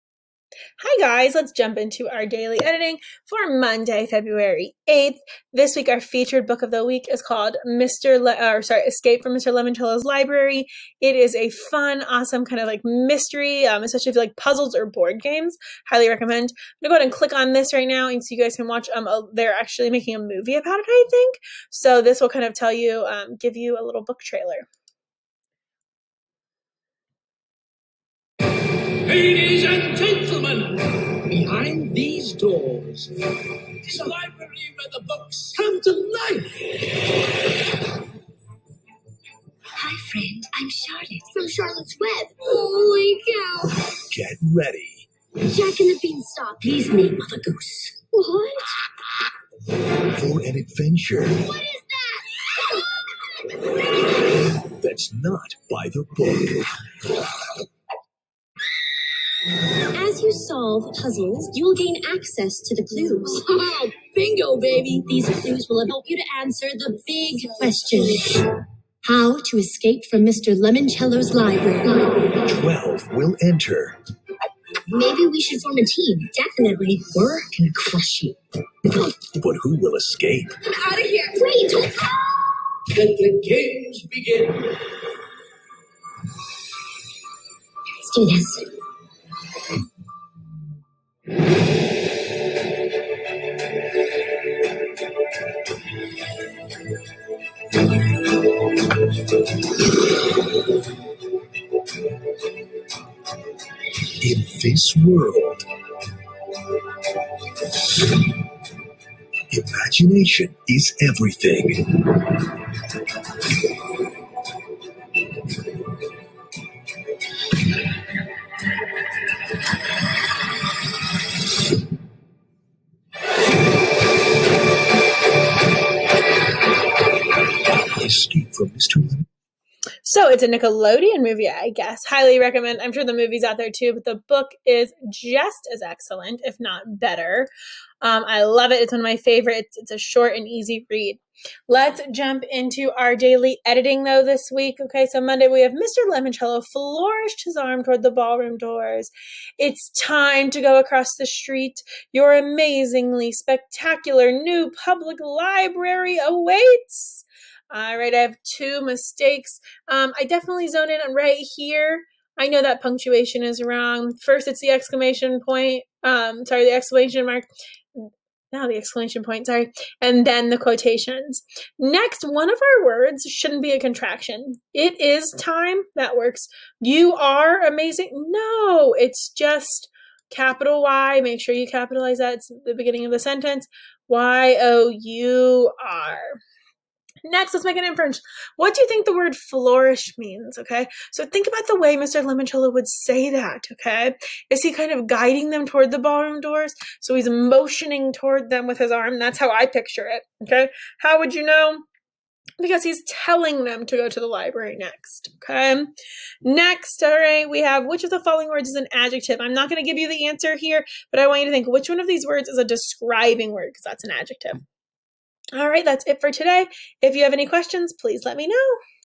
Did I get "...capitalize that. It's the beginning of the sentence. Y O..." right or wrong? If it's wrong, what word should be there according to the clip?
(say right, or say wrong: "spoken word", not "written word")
right.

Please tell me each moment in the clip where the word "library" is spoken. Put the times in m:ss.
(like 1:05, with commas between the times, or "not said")
0:10, 0:34, 1:11, 2:35, 3:24.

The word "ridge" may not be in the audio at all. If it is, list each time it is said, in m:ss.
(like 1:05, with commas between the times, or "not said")
not said.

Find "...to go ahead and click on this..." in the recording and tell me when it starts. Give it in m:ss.
0:16.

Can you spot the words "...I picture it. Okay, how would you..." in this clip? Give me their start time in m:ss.
3:19.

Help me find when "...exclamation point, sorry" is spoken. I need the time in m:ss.
2:48.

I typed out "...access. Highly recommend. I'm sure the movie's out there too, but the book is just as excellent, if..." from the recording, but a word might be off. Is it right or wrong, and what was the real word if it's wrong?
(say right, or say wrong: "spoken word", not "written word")
wrong: "guess", not "access".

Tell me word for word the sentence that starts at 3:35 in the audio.
All right, that's it for today.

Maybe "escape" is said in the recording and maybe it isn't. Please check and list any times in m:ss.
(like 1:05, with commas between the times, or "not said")
0:08, 1:09, 1:19.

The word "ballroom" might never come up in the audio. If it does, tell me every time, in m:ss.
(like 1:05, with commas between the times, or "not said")
2:28, 3:15.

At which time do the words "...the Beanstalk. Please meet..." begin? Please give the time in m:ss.
0:45.